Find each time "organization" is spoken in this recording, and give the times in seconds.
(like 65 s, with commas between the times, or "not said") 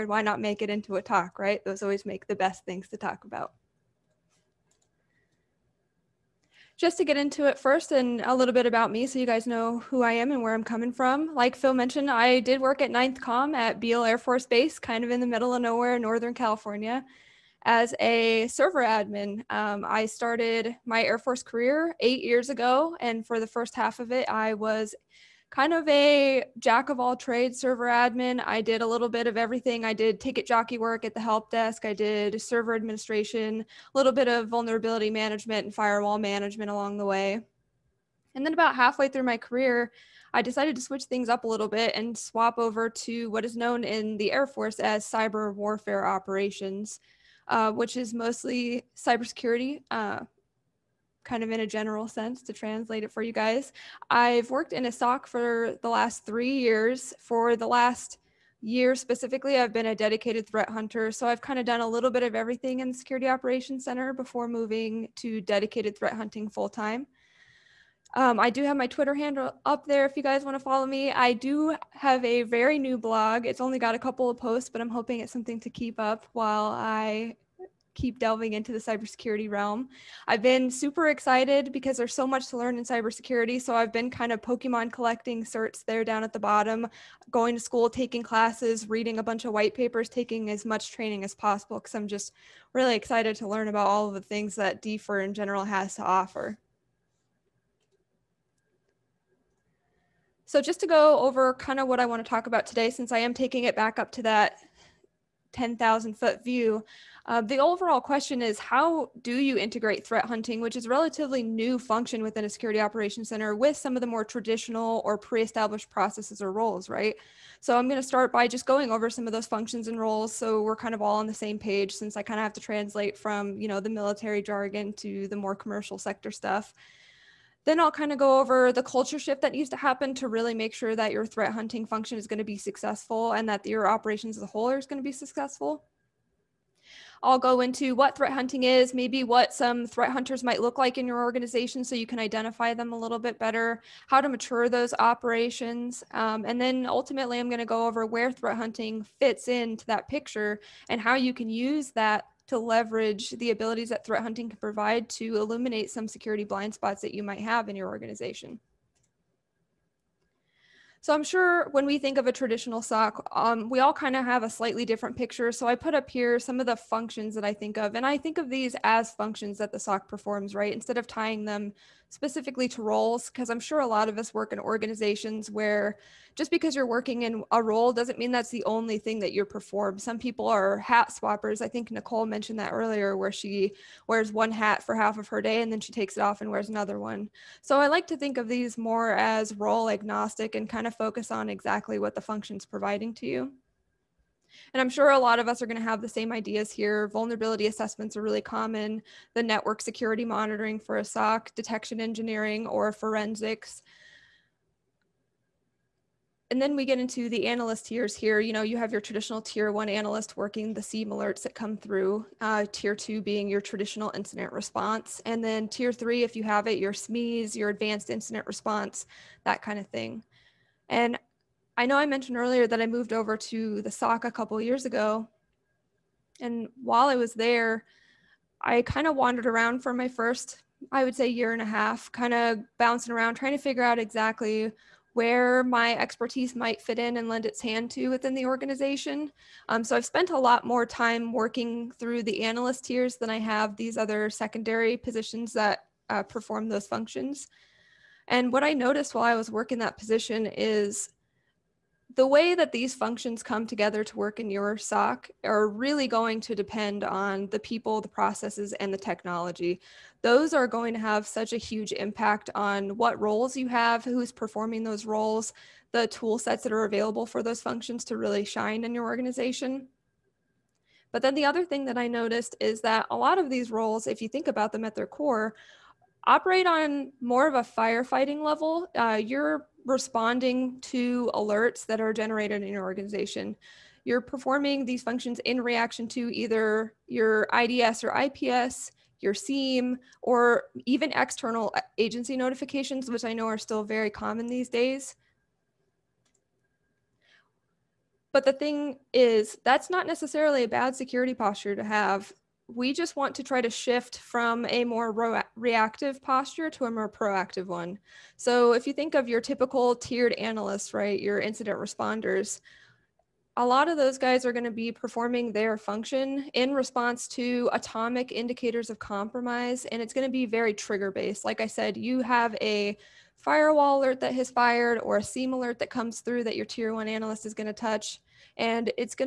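141 s, 157 s, 174 s, 238 s, 269 s, 282 s.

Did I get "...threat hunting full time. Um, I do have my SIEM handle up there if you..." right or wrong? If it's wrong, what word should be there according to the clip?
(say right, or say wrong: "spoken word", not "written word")
wrong: "Twitter", not "SIEM".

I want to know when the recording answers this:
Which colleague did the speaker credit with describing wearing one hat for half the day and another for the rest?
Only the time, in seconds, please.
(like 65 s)
181 s.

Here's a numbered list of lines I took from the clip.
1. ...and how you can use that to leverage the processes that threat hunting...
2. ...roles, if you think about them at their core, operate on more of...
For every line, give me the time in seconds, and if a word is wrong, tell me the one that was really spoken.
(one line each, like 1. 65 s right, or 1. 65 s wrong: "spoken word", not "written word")
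1. 150 s wrong: "abilities", not "processes"
2. 273 s right.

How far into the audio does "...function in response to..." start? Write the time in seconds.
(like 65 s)
315 s.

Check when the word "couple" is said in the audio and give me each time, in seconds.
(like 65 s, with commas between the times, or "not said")
73 s, 224 s.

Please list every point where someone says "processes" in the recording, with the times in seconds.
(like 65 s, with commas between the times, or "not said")
115 s, 258 s.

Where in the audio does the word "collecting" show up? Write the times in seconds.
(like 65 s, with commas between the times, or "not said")
84 s.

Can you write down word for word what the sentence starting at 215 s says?
And then tier three, if you have it, your SMEs, your advanced incident response, that kind of thing.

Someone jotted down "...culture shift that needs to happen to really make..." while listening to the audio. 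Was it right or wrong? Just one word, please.
right.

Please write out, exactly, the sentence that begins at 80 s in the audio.
I've been super excited because there's so much to learn in cybersecurity.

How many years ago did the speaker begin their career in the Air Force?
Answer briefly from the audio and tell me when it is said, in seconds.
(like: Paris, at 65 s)
8, at 21 s.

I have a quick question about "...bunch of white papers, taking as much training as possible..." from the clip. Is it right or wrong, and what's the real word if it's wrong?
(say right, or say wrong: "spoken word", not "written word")
right.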